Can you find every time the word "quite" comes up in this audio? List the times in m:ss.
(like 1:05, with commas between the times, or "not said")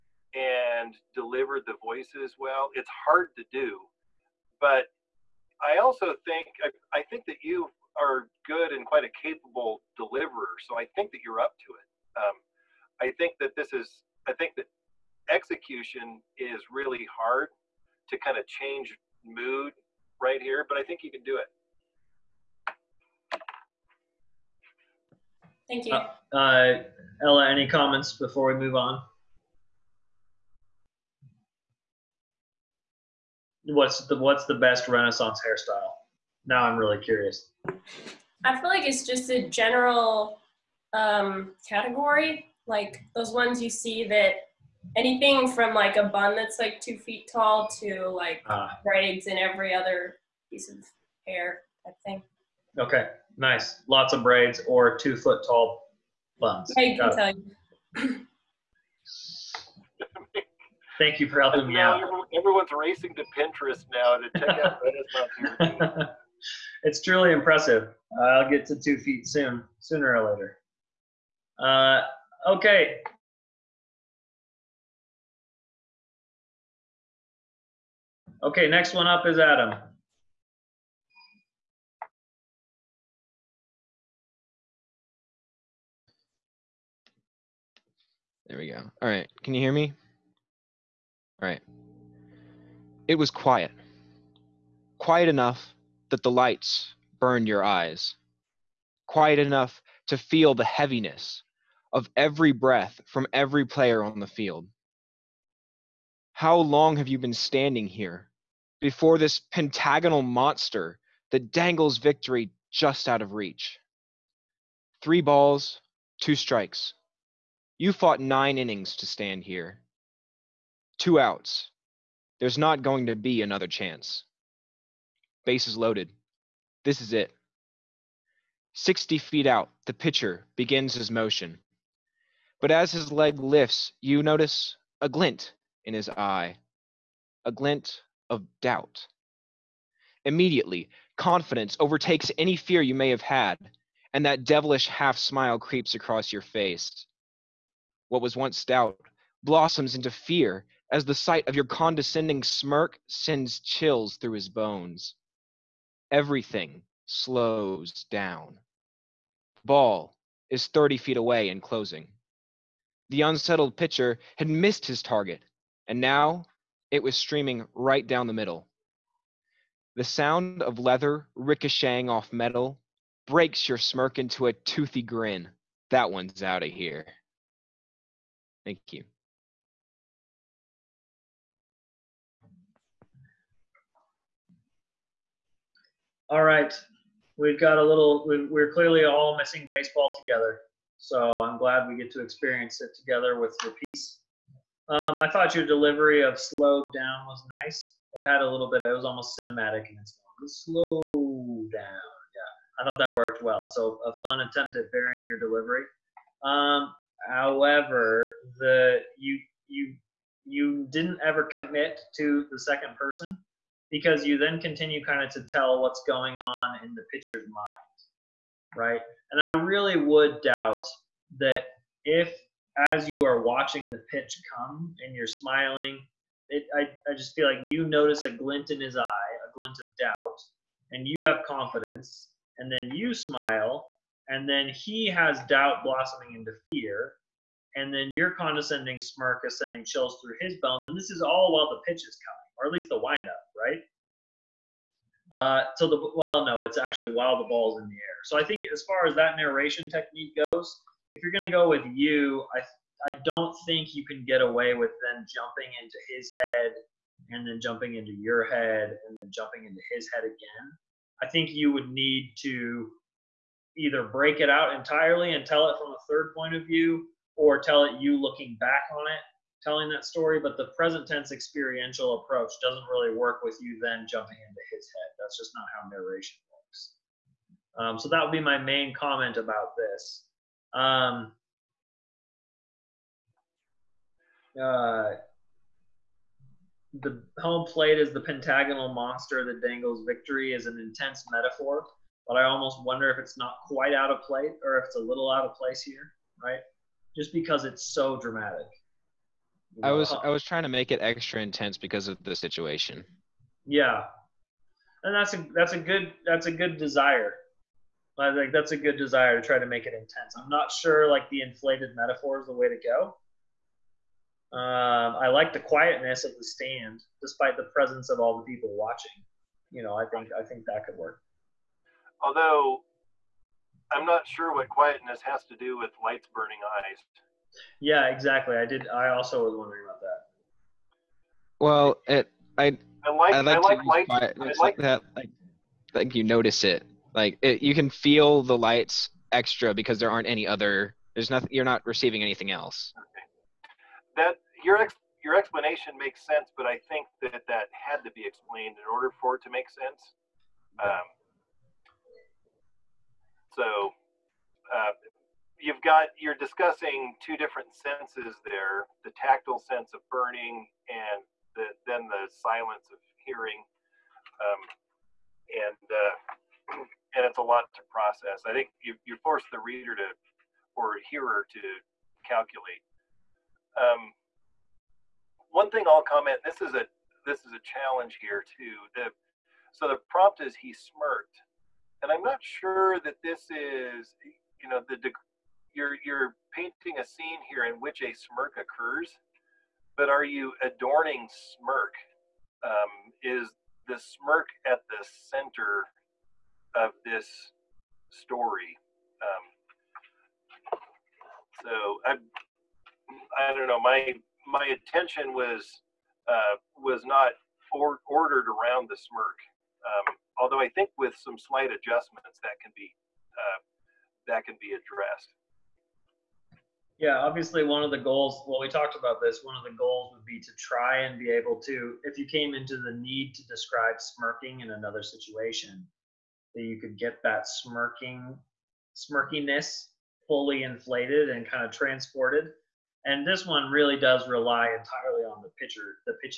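0:08, 4:53.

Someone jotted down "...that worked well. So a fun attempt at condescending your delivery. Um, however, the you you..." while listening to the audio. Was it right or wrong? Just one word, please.
wrong.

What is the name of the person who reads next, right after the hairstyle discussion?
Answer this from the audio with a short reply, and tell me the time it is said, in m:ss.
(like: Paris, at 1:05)
Adam, at 1:19.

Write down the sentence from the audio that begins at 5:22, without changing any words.
Although, I'm not sure what quietness has to do with lights burning eyes.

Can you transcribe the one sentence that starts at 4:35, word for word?
That's just not how narration works.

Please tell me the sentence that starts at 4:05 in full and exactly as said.
Uh, so the well, no, it's actually while the ball's in the air.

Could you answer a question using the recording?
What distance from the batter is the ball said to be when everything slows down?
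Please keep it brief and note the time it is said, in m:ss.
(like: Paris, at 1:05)
30 feet, at 2:40.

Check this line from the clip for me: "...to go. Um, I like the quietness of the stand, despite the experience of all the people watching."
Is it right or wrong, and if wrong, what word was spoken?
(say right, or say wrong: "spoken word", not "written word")
wrong: "presence", not "experience".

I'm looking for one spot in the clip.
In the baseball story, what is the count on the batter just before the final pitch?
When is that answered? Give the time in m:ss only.
1:55.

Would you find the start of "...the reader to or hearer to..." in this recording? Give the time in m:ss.
6:09.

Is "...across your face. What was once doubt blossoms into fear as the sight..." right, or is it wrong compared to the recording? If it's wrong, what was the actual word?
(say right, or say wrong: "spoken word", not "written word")
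right.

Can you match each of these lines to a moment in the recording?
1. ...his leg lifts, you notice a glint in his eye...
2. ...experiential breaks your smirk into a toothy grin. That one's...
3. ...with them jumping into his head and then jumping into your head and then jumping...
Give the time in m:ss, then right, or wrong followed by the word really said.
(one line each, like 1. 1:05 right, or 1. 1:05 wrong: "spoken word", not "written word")
1. 2:12 right
2. 2:52 wrong: "metal", not "experiential"
3. 4:14 right.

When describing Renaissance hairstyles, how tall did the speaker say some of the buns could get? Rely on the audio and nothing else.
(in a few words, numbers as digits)
2 feet.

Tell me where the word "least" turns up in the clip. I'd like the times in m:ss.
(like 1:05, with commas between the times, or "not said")
4:02.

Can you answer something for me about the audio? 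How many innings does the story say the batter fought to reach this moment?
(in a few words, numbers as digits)
9.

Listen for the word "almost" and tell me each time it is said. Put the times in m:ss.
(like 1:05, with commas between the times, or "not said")
3:19, 4:52.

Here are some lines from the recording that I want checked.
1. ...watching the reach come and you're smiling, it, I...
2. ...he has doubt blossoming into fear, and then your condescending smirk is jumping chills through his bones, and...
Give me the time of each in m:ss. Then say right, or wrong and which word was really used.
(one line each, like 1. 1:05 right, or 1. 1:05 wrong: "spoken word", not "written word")
1. 3:43 wrong: "pitch", not "reach"
2. 3:54 wrong: "sending", not "jumping".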